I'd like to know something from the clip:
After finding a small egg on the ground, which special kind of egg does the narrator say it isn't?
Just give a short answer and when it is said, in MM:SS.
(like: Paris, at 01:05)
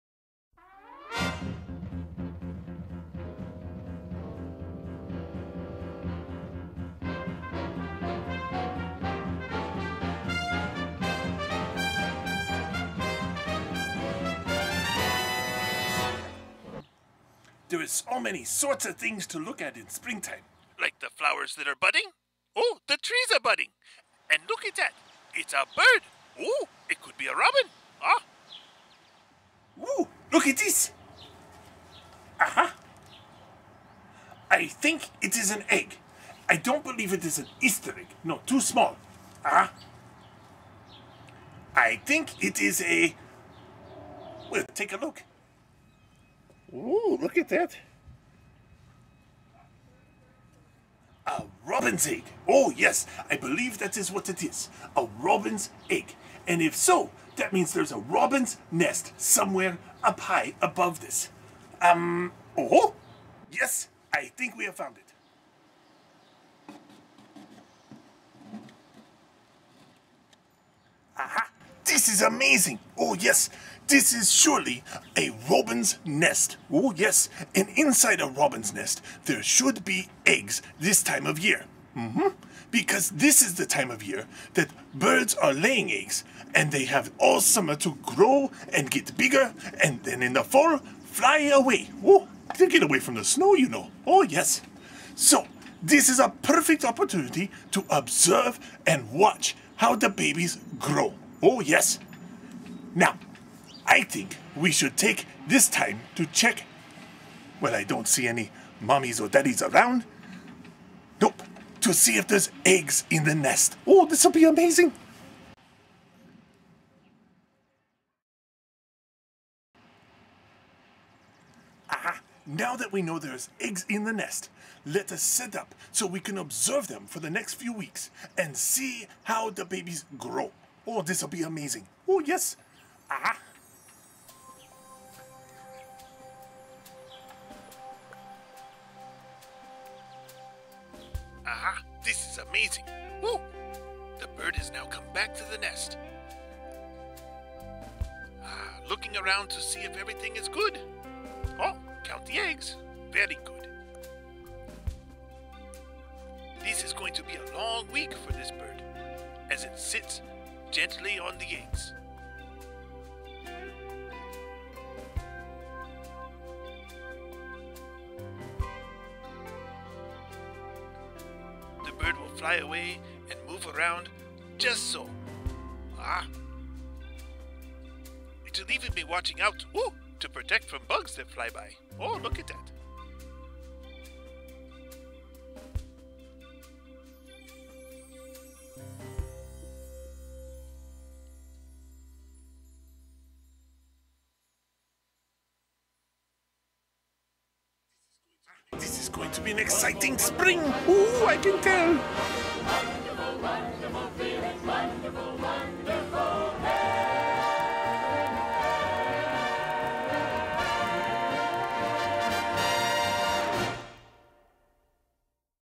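Easter egg, at 00:37.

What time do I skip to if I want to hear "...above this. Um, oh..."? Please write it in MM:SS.
01:00.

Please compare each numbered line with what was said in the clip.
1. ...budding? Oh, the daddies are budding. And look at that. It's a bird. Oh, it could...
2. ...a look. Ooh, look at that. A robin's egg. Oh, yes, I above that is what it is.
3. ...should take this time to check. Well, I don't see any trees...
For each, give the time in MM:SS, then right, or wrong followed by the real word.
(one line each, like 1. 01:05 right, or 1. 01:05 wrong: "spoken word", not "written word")
1. 00:21 wrong: "trees", not "daddies"
2. 00:44 wrong: "believe", not "above"
3. 01:44 wrong: "mommies", not "trees".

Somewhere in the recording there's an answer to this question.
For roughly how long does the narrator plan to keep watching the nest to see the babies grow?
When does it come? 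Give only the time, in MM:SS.
02:07.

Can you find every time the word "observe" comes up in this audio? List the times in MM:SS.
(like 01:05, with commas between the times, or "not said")
01:37, 02:06.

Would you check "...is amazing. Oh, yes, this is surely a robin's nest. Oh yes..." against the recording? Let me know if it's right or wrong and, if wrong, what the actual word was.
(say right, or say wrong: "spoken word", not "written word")
right.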